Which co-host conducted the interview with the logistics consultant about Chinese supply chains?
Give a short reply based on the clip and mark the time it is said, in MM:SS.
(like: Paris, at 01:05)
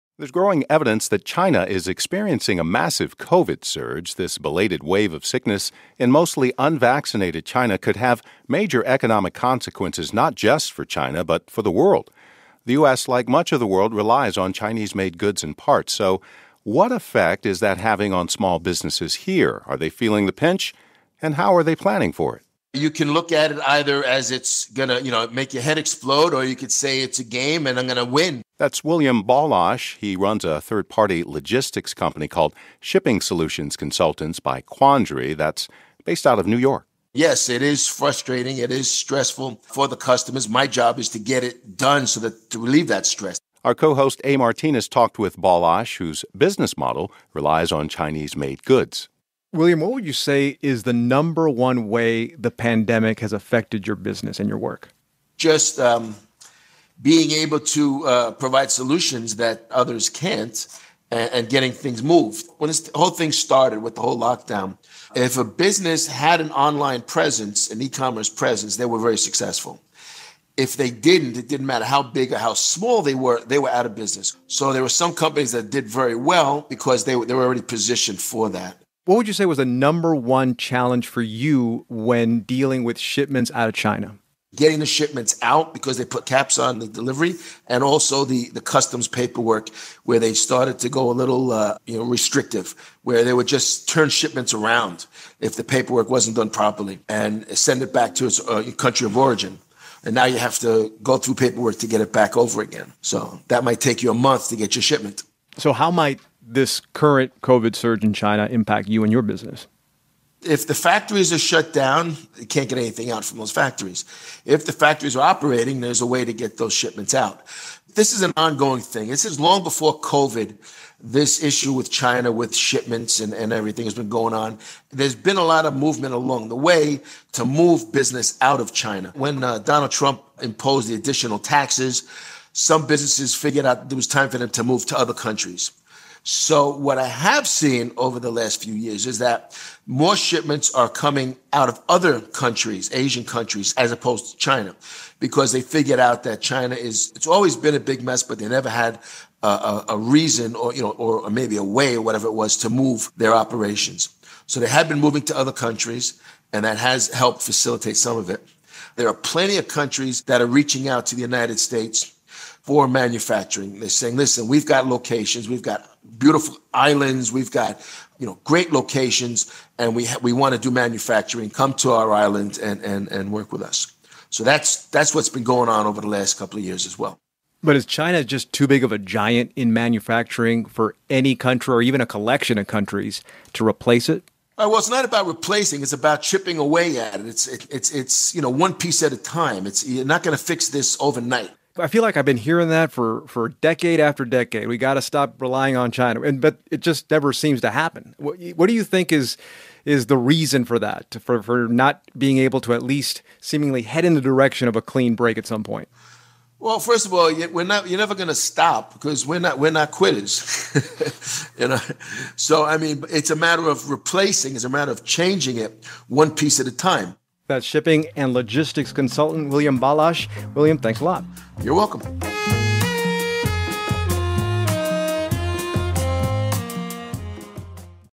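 A. Martinez, at 00:44.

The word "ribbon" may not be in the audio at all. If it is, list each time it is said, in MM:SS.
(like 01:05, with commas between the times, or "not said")
not said.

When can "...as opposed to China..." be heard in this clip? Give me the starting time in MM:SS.
02:23.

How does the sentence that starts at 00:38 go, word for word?
It is stressful for the customers.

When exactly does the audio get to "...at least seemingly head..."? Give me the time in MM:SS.
03:22.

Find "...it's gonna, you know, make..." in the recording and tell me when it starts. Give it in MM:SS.
00:24.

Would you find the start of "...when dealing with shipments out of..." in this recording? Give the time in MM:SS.
01:21.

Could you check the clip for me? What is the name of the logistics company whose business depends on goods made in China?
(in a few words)
Shipping Solutions Consultants by Quandary.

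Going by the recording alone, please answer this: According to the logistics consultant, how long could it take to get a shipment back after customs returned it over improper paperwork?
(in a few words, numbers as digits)
a month.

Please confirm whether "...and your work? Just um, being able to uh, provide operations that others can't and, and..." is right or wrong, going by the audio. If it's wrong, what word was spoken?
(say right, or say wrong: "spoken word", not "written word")
wrong: "solutions", not "operations".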